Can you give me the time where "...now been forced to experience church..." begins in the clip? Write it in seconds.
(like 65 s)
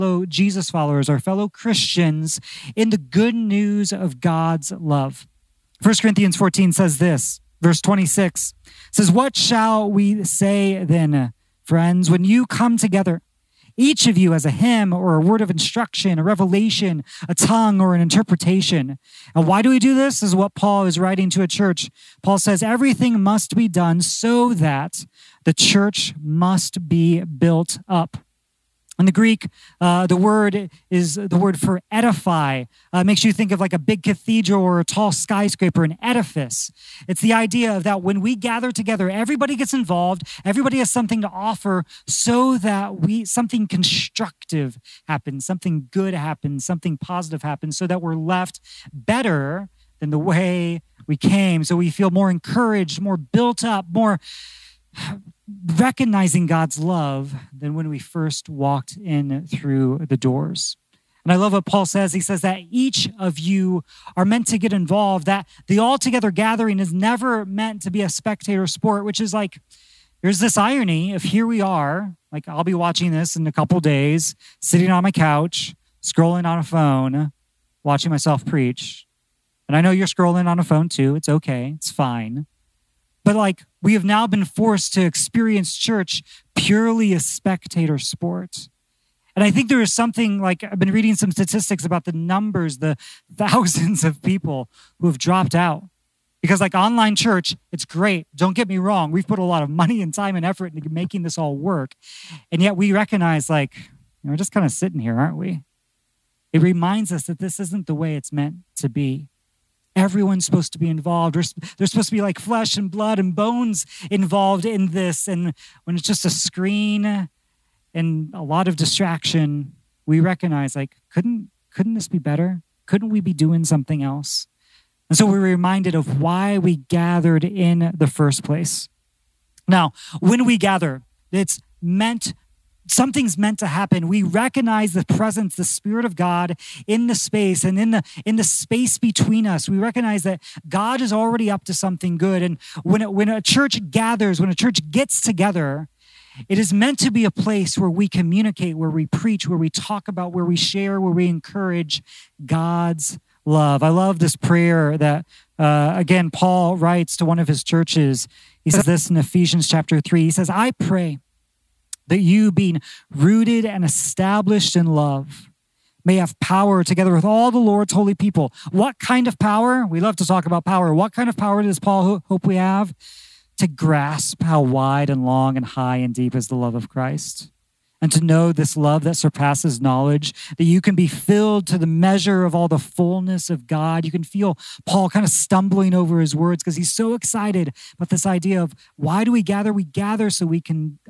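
84 s.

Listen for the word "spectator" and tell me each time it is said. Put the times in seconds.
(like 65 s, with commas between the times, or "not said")
68 s, 87 s.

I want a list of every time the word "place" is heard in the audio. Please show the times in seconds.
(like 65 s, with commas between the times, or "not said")
128 s, 147 s.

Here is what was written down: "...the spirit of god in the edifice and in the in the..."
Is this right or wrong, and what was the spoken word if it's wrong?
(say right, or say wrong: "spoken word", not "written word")
wrong: "space", not "edifice".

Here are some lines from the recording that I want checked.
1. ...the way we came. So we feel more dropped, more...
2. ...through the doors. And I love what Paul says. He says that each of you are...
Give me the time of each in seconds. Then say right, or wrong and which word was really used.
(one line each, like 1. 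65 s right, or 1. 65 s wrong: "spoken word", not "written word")
1. 50 s wrong: "encouraged", not "dropped"
2. 59 s right.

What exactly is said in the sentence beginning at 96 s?
Because, like online church, it's great.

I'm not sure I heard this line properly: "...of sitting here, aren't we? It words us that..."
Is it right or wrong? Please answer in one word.
wrong.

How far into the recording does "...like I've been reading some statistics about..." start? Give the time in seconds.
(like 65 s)
90 s.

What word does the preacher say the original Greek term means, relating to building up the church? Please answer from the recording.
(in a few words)
edify.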